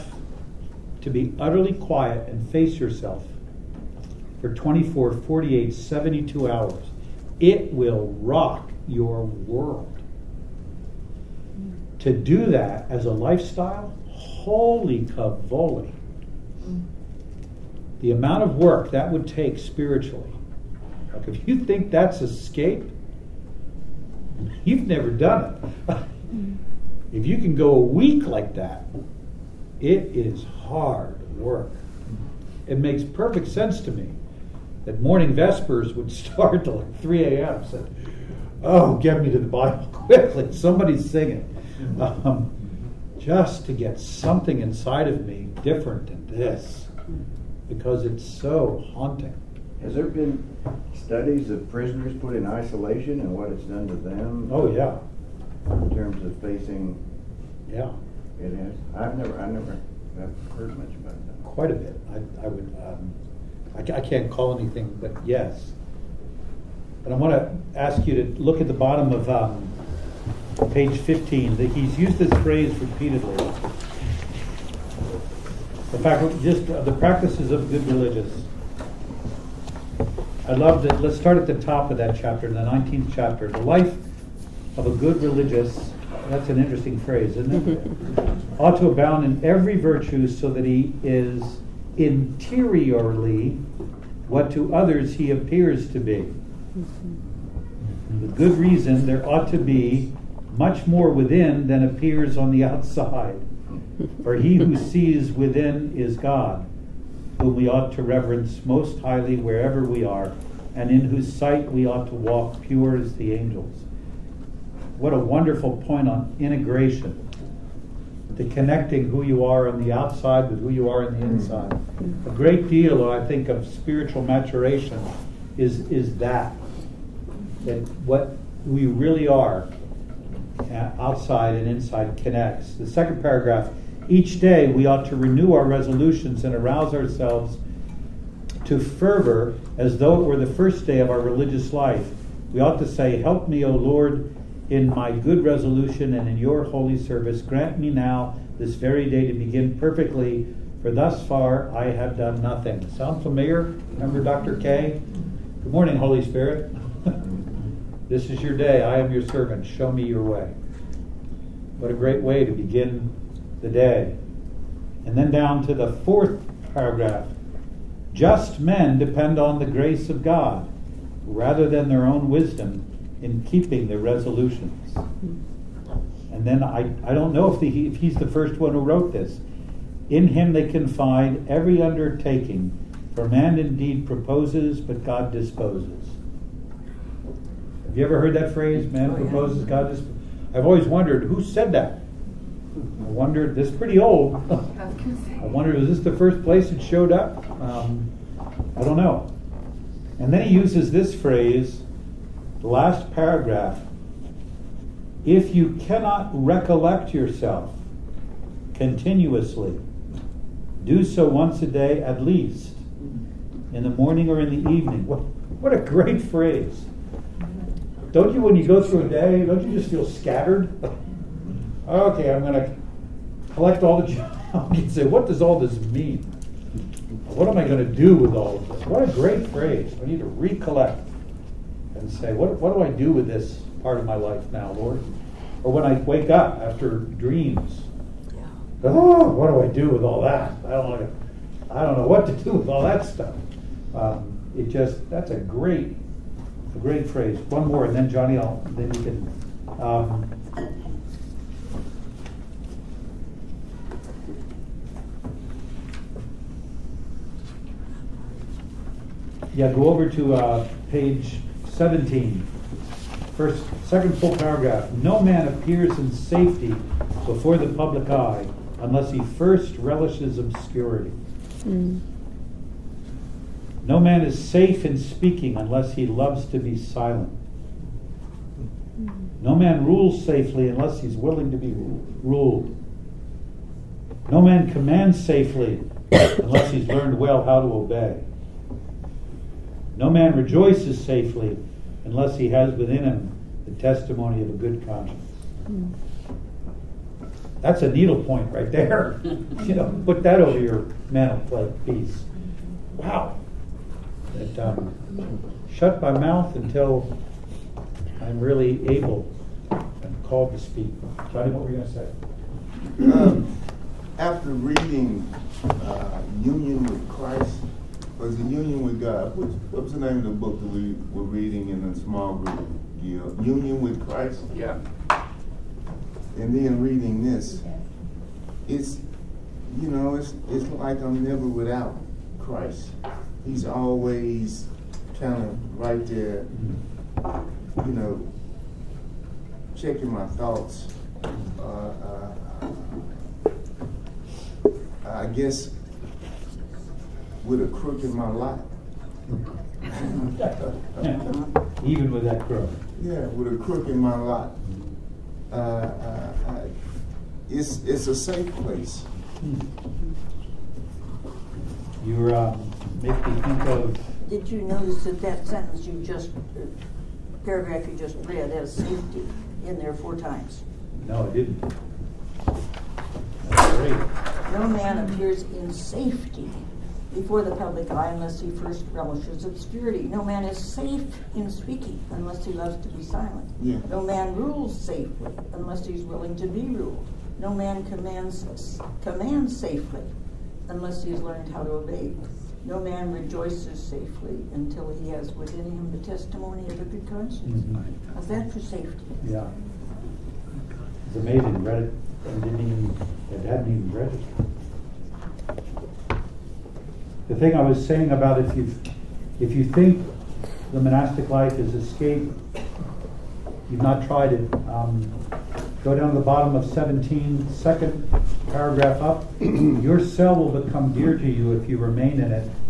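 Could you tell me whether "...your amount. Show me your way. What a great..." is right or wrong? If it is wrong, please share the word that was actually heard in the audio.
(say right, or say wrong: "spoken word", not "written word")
wrong: "servant", not "amount".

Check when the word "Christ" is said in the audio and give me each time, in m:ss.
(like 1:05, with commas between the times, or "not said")
5:17, 5:24, 5:32.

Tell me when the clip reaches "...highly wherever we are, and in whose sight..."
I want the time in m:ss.
1:49.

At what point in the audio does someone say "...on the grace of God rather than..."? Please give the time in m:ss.
2:49.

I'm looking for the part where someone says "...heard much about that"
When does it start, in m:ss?
1:00.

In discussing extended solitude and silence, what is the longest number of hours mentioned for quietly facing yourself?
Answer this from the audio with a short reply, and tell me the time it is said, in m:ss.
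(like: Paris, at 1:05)
72, at 0:05.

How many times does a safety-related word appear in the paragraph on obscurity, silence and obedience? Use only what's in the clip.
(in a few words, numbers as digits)
4.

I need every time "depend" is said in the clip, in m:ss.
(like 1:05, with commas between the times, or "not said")
2:48.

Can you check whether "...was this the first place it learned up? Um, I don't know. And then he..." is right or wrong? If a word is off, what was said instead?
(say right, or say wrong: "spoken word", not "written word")
wrong: "showed", not "learned".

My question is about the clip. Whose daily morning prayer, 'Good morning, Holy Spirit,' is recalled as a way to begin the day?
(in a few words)
Dr. K.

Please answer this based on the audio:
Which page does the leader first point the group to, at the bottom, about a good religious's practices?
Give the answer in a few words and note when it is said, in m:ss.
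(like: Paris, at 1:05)
15, at 1:10.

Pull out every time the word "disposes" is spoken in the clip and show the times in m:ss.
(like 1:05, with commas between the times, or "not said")
3:05, 3:09.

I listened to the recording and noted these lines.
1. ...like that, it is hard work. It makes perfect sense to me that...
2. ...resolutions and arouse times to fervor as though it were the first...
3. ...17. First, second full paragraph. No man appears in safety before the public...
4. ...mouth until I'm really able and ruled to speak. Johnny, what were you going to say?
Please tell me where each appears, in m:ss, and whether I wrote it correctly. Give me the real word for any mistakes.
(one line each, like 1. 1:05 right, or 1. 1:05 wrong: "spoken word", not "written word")
1. 0:28 right
2. 2:15 wrong: "ourselves", not "times"
3. 4:21 right
4. 5:06 wrong: "called", not "ruled".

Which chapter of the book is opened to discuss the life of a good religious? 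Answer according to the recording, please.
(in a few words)
19th.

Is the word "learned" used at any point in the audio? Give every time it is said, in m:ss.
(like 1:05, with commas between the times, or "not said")
4:46, 6:31.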